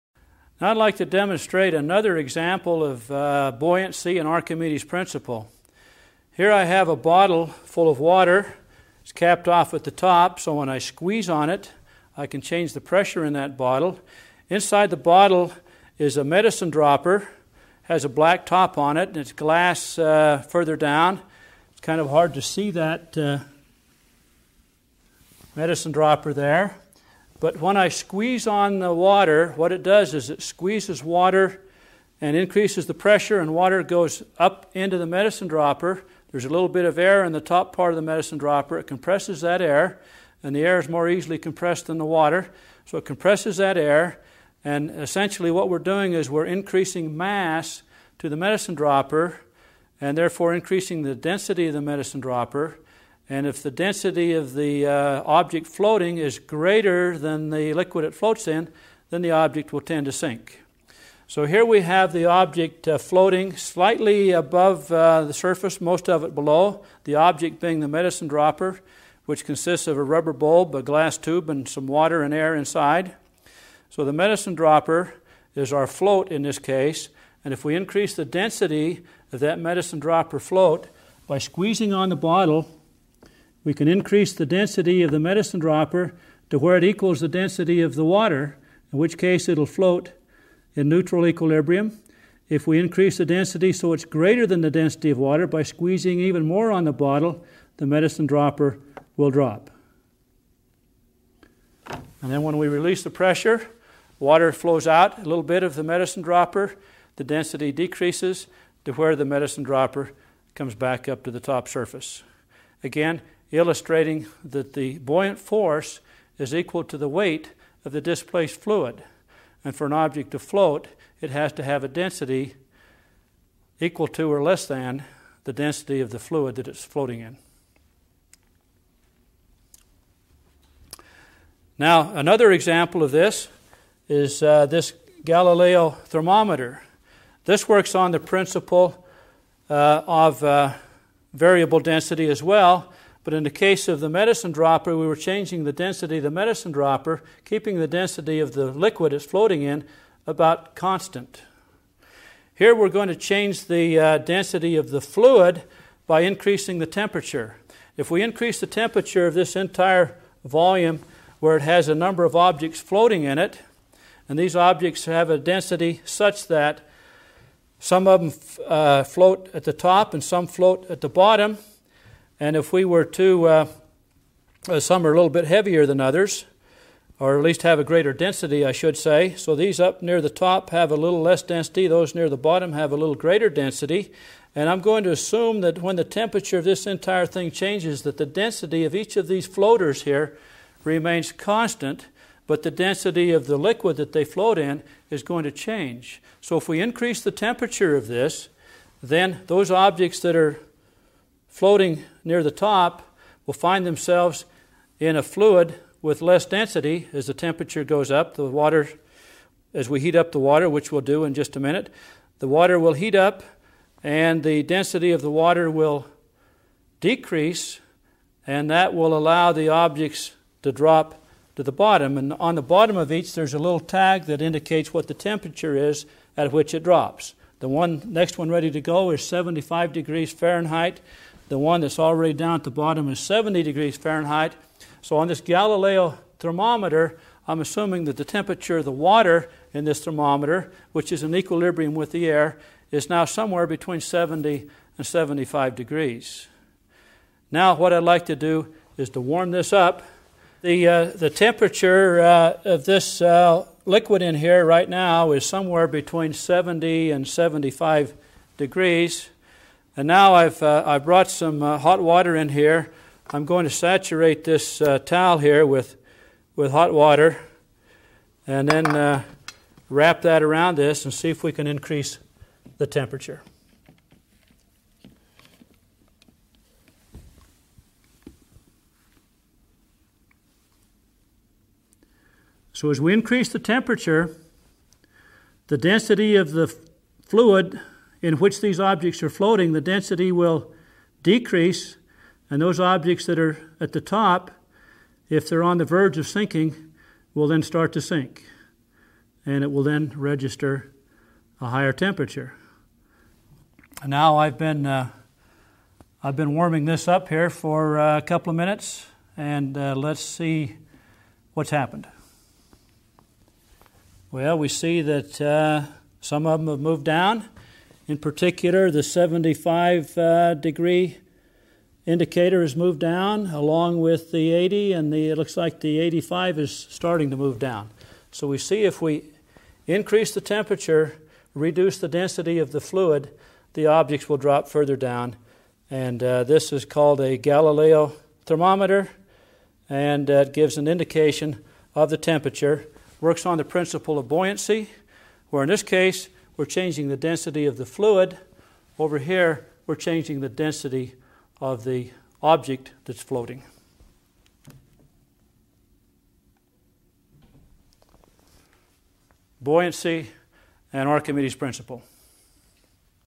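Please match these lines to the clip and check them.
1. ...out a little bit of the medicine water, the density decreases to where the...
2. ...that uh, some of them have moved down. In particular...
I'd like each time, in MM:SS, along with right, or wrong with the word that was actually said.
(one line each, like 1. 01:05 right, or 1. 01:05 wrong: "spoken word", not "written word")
1. 01:44 wrong: "dropper", not "water"
2. 05:15 right.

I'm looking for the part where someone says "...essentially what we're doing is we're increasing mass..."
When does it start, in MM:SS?
00:44.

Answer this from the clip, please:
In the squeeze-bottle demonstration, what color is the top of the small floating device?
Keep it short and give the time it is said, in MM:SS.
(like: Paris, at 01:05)
Black, at 00:18.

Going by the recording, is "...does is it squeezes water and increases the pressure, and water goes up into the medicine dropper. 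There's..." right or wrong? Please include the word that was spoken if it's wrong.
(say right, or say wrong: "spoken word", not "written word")
right.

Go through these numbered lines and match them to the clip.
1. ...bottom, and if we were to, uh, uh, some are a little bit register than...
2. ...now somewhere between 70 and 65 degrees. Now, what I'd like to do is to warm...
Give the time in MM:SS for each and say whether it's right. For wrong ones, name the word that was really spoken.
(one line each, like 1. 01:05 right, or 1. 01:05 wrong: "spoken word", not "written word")
1. 02:51 wrong: "heavier", not "register"
2. 04:03 wrong: "75", not "65".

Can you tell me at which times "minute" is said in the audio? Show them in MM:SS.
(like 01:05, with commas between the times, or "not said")
03:31, 05:08.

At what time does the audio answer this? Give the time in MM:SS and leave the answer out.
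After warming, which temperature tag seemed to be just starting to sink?
05:26.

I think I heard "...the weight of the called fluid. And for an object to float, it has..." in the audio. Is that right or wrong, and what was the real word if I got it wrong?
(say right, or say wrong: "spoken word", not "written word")
wrong: "displaced", not "called".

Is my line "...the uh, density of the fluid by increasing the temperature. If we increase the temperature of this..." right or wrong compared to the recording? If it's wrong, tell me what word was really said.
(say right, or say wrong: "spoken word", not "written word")
right.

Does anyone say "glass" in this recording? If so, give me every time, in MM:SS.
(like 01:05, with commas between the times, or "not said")
00:19, 01:10.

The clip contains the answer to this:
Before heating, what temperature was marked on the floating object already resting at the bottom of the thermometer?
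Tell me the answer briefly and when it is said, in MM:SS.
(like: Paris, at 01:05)
70 degrees Fahrenheit, at 03:53.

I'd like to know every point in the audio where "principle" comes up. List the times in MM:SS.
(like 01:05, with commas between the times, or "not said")
00:04, 02:18, 05:43, 06:01.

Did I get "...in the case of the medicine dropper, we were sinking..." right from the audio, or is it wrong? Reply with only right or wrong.
wrong.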